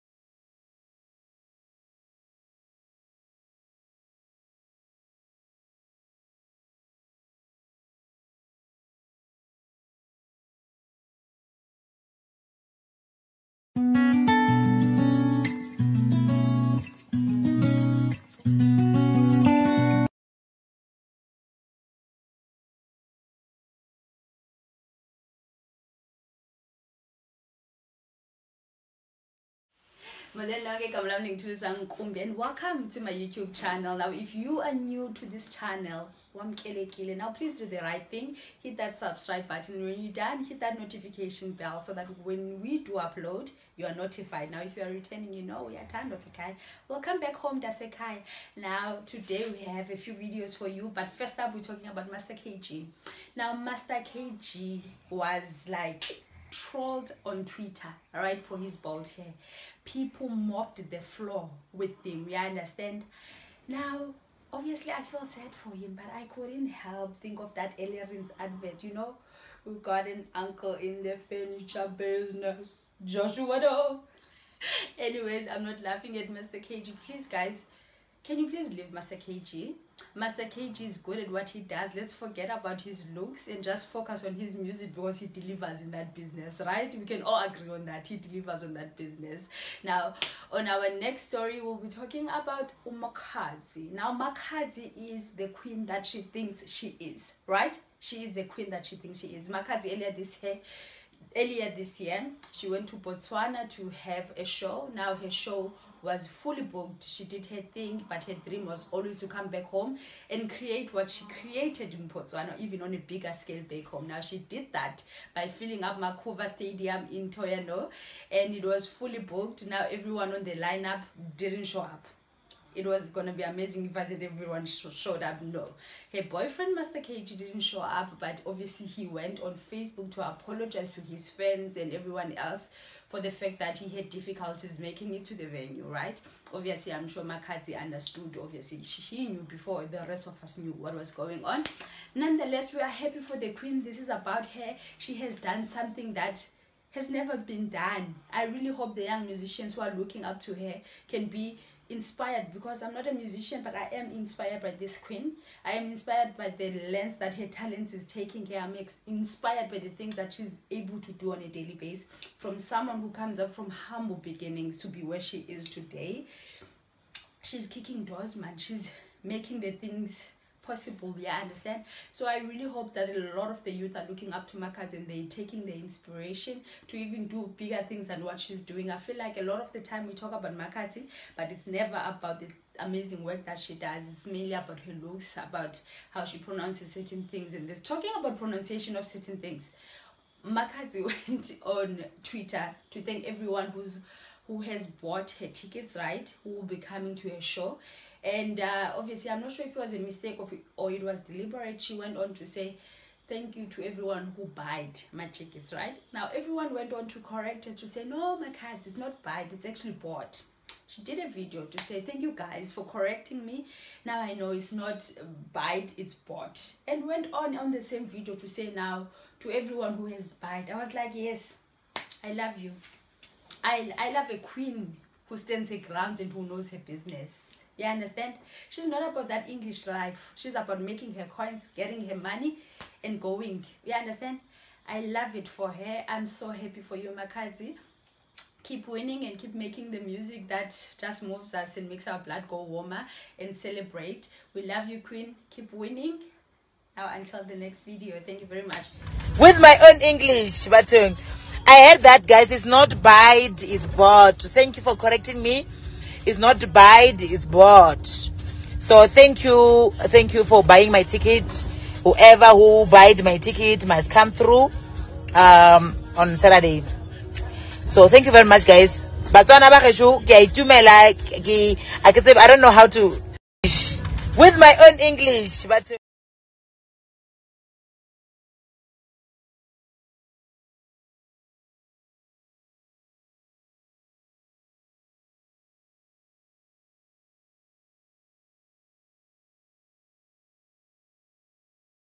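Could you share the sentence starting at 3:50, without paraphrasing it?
She's about making her coins, getting her money, and going.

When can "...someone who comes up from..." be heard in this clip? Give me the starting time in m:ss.
2:42.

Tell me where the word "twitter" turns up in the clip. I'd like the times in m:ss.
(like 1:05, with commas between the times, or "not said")
0:57, 3:12.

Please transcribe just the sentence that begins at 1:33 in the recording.
Now, Makhadzi is the queen that she thinks she is, right?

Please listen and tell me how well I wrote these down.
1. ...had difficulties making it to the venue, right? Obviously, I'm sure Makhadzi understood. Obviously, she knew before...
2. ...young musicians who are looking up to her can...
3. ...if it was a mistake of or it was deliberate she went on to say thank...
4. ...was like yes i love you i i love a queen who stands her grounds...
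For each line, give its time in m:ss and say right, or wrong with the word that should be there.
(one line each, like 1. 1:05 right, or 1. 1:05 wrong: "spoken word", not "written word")
1. 2:13 right
2. 2:29 right
3. 3:19 right
4. 3:40 right.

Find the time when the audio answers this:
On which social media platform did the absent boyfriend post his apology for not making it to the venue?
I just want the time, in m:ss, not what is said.
2:09.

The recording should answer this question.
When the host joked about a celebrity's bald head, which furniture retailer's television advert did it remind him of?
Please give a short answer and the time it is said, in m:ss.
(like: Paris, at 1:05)
Ellerines, at 1:07.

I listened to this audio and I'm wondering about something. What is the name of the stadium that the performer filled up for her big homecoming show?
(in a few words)
Makhuvha Stadium.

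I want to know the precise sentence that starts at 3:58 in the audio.
Keep winning and keep making the music that just moves us and makes our blood go warmer and celebrate.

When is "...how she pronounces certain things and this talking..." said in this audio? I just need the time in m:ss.
3:06.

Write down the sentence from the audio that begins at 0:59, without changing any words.
People mopped the floor with him, you understand?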